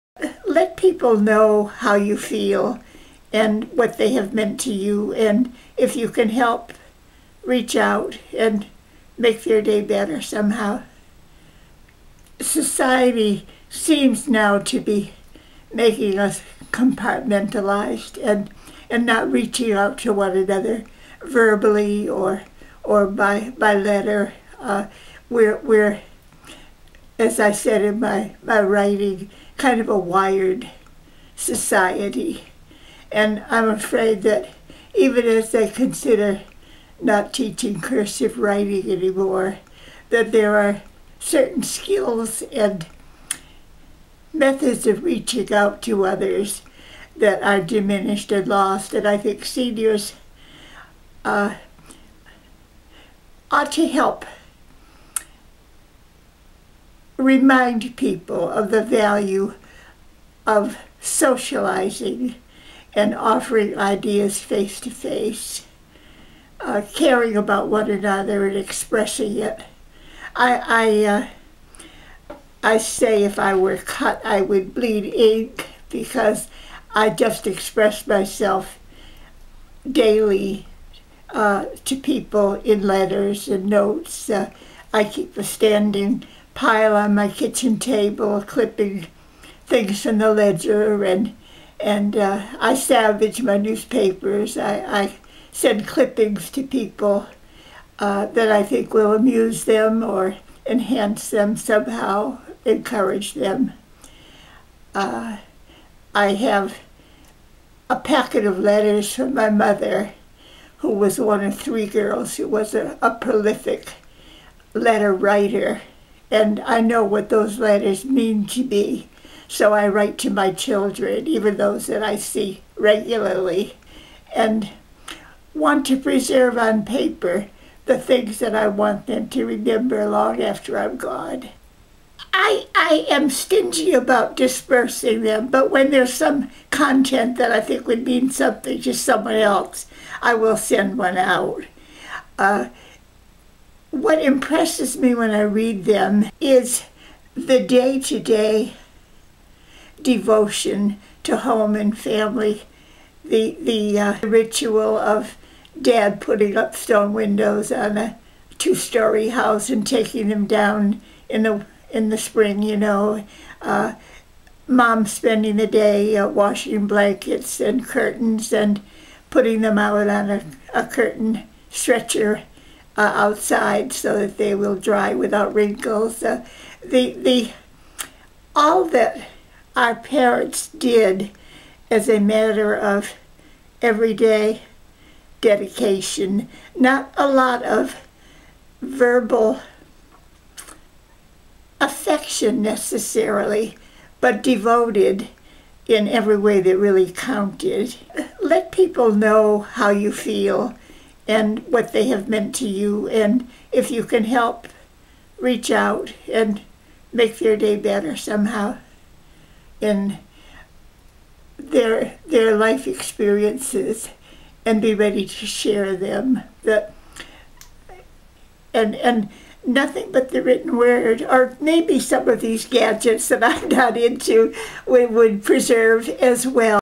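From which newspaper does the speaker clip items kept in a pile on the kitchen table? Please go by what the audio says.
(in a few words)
the Ledger.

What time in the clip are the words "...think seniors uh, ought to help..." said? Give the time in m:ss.
0:49.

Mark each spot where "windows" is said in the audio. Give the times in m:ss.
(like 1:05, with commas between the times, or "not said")
2:37.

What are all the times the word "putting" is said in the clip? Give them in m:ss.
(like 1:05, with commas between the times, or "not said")
2:36, 2:49.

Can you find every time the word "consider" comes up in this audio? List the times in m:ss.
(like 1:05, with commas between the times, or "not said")
0:35.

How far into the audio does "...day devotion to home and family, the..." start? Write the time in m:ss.
2:28.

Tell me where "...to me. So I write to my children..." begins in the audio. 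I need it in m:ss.
1:58.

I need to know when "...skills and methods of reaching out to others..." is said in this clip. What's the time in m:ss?
0:41.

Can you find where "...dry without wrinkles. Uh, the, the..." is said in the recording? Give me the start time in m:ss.
2:54.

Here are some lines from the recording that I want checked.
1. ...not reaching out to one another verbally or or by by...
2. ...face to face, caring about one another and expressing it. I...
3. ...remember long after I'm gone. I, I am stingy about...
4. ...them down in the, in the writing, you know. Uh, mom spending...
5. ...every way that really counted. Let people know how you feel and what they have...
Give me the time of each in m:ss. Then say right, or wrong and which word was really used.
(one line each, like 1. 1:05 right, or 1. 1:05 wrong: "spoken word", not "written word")
1. 0:19 right
2. 1:04 right
3. 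2:09 right
4. 2:40 wrong: "spring", not "writing"
5. 3:16 right.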